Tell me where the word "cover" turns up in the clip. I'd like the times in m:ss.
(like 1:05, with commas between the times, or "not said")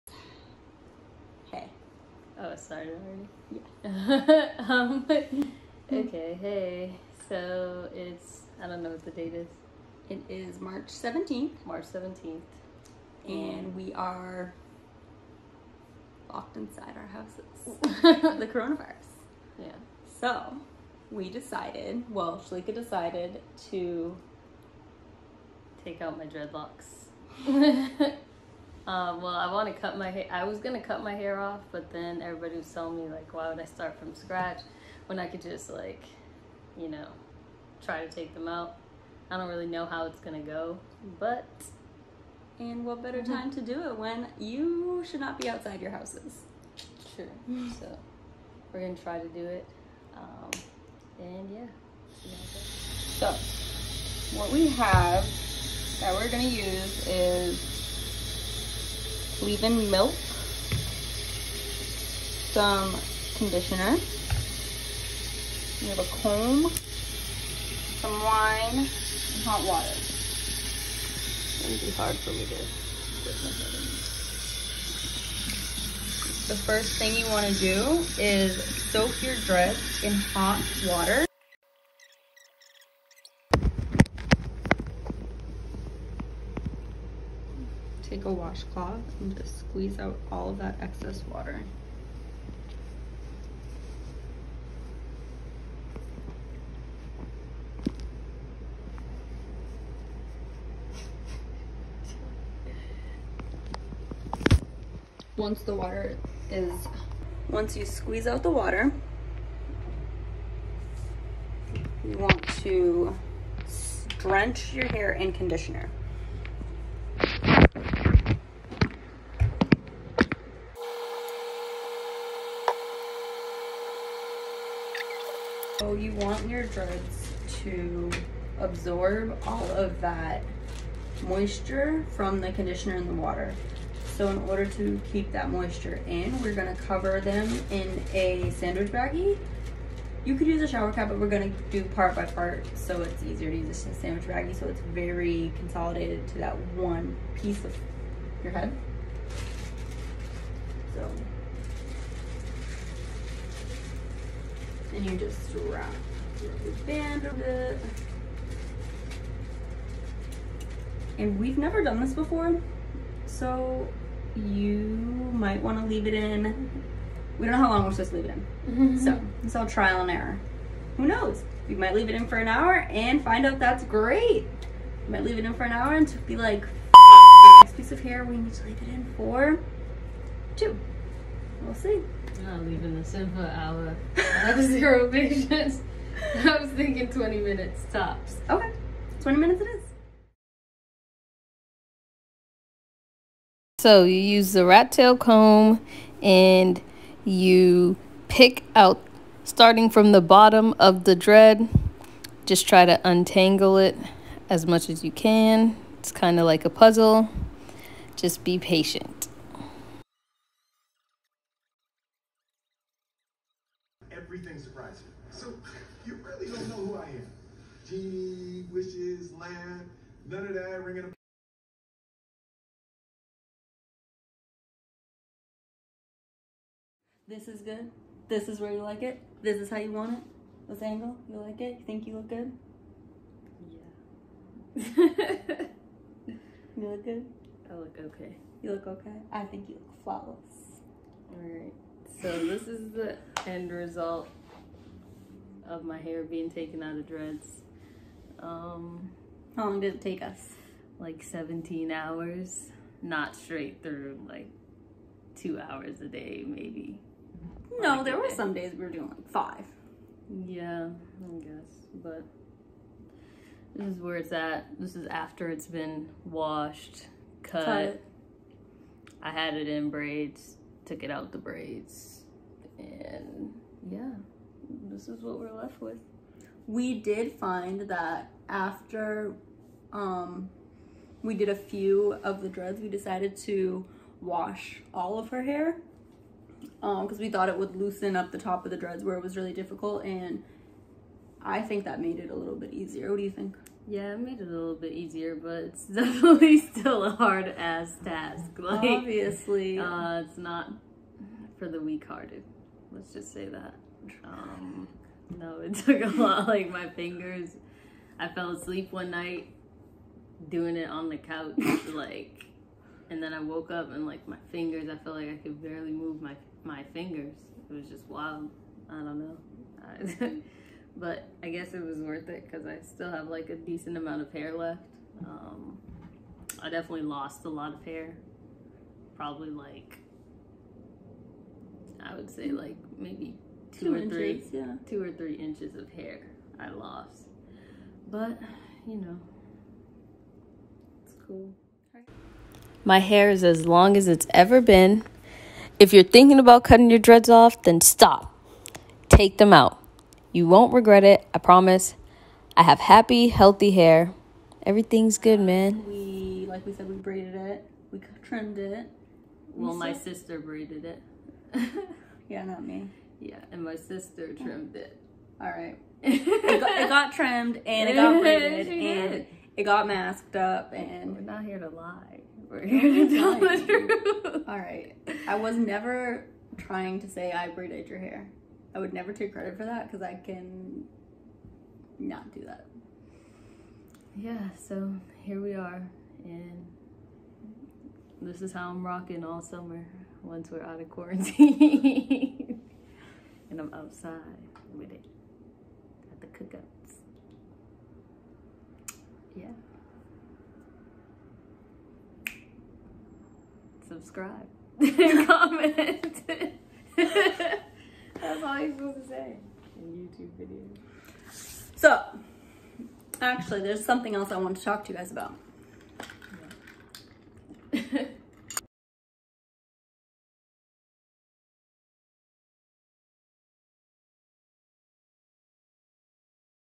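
2:16.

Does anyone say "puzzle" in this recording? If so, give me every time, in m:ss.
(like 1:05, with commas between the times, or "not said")
3:26.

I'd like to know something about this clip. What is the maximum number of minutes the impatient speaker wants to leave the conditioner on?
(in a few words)
20 minutes.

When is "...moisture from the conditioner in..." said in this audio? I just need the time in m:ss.
2:11.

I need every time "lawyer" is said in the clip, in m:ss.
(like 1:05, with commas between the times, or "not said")
not said.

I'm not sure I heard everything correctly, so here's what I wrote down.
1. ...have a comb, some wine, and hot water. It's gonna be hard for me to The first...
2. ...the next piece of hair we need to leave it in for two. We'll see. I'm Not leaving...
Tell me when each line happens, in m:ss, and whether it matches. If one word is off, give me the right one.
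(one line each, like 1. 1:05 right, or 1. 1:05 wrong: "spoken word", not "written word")
1. 1:05 right
2. 2:56 right.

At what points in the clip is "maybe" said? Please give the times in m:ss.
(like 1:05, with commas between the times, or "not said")
4:16, 5:32.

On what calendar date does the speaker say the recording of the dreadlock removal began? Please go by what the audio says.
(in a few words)
March 17th.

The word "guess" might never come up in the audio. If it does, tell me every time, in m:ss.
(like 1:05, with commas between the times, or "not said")
4:21, 5:21.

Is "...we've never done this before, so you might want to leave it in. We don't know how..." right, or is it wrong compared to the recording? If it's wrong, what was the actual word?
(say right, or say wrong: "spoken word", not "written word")
right.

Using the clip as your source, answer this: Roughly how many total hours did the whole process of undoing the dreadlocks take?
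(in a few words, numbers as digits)
17 hours.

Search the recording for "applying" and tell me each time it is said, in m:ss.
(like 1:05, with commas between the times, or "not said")
not said.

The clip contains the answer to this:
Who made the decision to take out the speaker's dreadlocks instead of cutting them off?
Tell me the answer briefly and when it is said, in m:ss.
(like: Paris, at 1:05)
Shalika, at 0:22.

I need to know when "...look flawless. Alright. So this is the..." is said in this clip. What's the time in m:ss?
3:59.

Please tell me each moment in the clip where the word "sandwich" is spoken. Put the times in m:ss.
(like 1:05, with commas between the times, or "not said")
2:18, 2:23.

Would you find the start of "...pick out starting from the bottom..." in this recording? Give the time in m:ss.
3:18.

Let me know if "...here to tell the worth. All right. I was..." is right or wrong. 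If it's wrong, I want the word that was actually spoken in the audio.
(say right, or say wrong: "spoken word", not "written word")
wrong: "truth", not "worth".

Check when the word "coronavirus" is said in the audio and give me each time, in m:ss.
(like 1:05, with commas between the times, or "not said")
0:18.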